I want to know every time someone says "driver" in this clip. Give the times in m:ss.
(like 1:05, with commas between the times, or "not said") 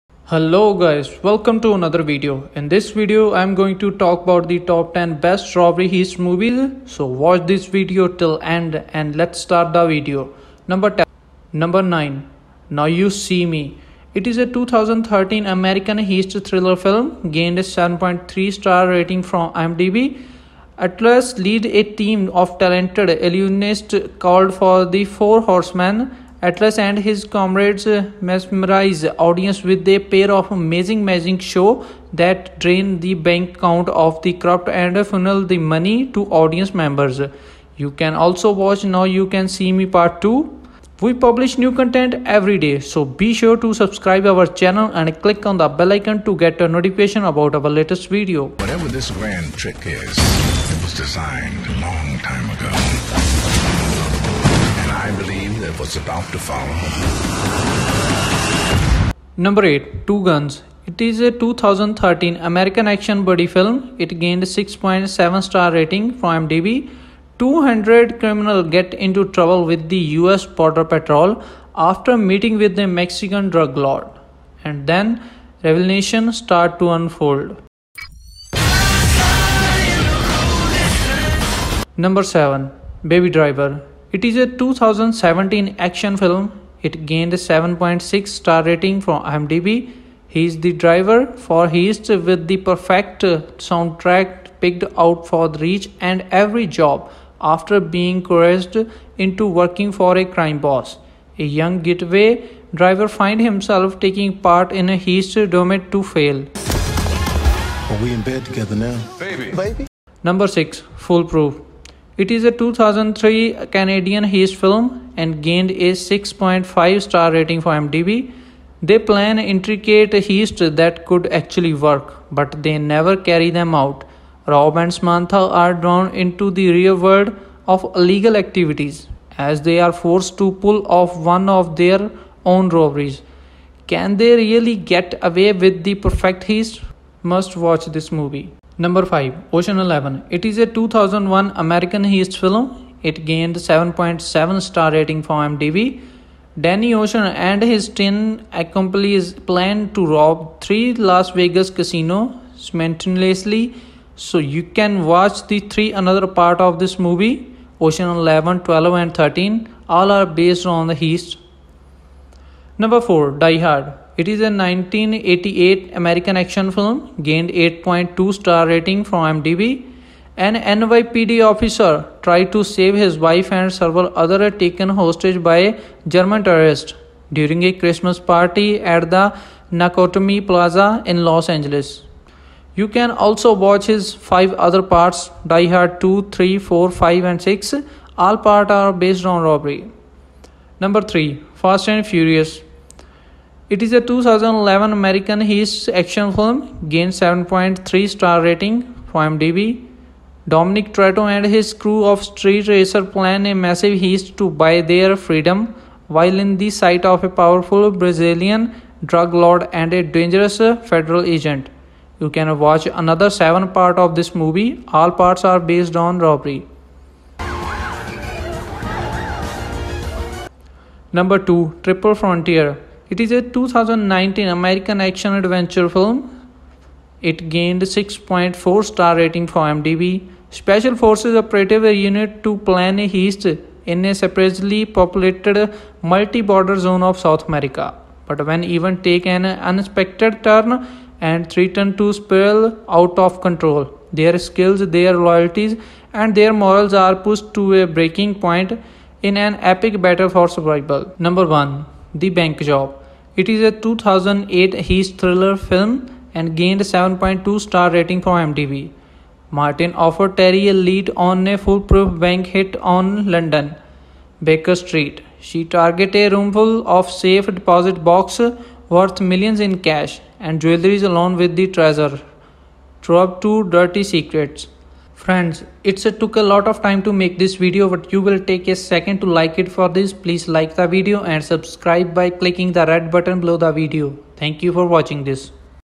1:23, 1:30, 1:42.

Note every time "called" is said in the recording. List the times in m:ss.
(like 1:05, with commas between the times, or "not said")
0:24.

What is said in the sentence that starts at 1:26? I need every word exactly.
It gained a 7.6 star rating from IMDb.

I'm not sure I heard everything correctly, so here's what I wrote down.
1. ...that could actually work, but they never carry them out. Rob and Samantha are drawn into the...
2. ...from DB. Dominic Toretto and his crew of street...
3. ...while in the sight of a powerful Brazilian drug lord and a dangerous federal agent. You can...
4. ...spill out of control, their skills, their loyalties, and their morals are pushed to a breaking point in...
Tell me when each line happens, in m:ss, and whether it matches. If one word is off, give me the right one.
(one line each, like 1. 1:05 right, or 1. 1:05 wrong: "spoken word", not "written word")
1. 2:00 right
2. 3:19 right
3. 3:26 right
4. 4:02 right.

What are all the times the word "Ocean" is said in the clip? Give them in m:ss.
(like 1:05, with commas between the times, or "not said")
2:19, 2:27, 2:37.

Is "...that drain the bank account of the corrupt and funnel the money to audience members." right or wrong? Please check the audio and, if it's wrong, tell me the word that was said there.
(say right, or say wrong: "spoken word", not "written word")
right.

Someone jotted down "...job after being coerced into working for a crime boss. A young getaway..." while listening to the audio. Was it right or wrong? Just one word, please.
right.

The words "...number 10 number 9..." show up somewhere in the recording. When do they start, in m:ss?
0:10.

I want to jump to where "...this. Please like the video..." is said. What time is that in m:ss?
4:39.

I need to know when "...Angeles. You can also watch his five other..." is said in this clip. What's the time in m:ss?
3:01.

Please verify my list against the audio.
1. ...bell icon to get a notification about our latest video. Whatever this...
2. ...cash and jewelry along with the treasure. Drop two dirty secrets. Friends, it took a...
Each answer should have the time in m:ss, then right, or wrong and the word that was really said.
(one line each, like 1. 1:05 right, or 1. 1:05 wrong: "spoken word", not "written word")
1. 0:45 right
2. 4:29 right.